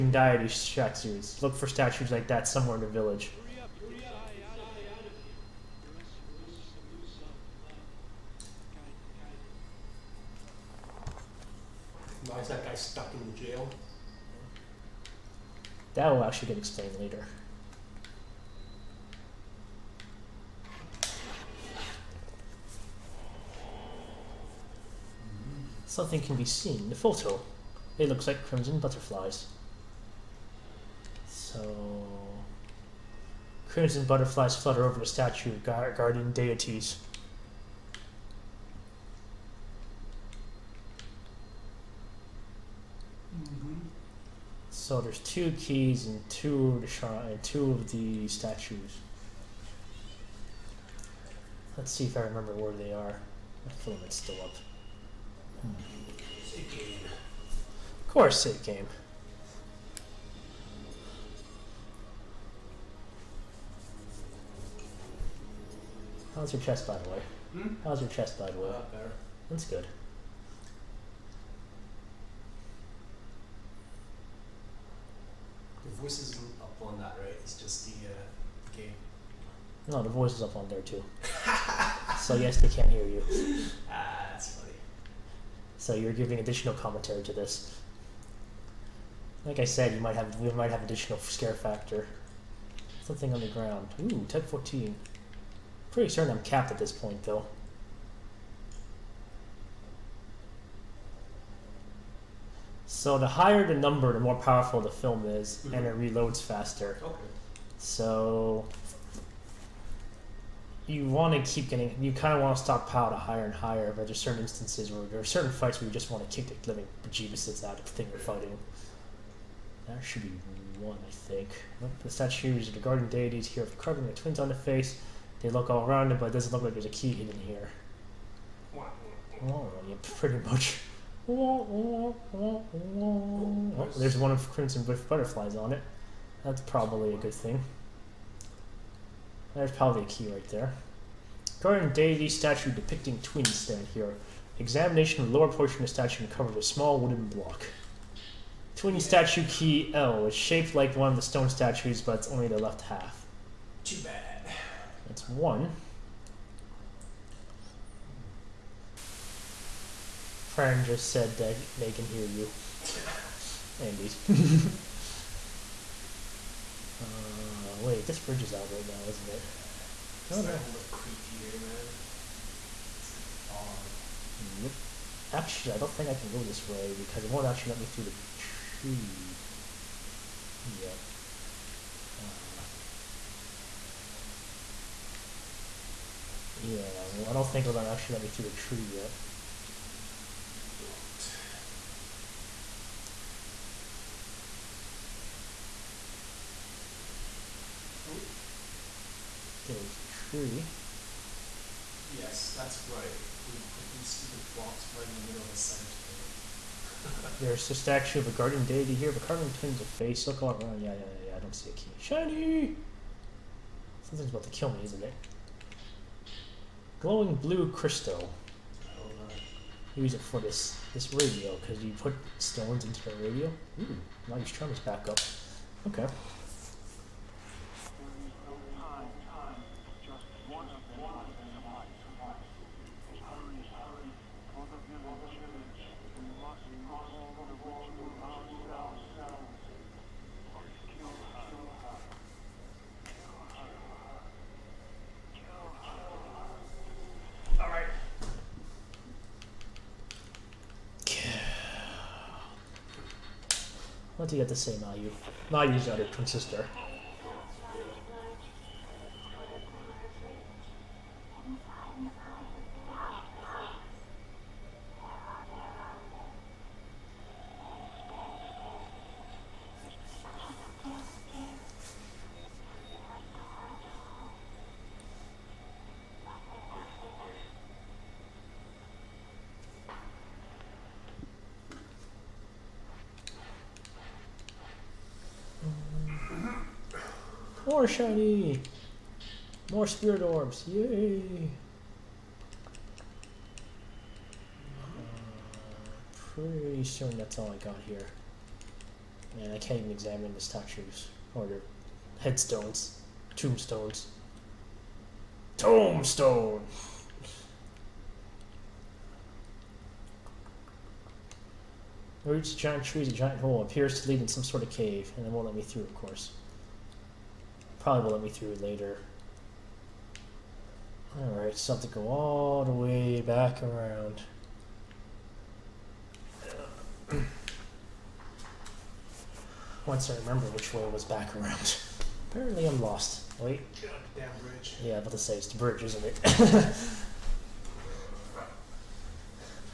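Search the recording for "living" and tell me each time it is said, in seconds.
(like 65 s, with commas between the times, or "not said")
116 s.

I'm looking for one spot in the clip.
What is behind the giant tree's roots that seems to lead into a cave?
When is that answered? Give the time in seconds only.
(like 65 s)
313 s.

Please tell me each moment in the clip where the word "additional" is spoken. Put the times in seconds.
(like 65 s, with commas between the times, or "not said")
86 s, 90 s.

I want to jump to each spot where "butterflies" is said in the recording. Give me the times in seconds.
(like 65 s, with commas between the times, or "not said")
28 s, 34 s, 135 s.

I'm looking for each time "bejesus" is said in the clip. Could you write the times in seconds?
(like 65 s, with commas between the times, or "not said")
117 s.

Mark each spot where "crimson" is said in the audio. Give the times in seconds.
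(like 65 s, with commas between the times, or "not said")
28 s, 33 s, 134 s.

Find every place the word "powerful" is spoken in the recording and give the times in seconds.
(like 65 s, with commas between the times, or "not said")
104 s.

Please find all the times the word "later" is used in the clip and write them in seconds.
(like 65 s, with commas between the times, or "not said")
16 s, 318 s.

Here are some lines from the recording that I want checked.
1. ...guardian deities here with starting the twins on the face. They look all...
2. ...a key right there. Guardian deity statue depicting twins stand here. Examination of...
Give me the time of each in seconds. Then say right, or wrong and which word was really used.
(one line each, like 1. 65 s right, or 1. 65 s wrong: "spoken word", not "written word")
1. 122 s wrong: "carving", not "starting"
2. 140 s right.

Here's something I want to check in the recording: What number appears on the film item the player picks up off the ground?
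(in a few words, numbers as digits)
1014.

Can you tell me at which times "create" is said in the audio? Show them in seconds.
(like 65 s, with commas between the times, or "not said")
not said.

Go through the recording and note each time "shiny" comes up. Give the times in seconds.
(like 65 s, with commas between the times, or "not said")
211 s, 287 s.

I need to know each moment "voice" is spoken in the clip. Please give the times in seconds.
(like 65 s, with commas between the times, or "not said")
76 s, 80 s.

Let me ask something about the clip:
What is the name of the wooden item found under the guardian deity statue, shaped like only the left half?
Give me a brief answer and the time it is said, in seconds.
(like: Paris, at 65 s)
Twin statue key L, at 148 s.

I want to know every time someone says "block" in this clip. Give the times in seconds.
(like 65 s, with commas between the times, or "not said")
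147 s, 204 s.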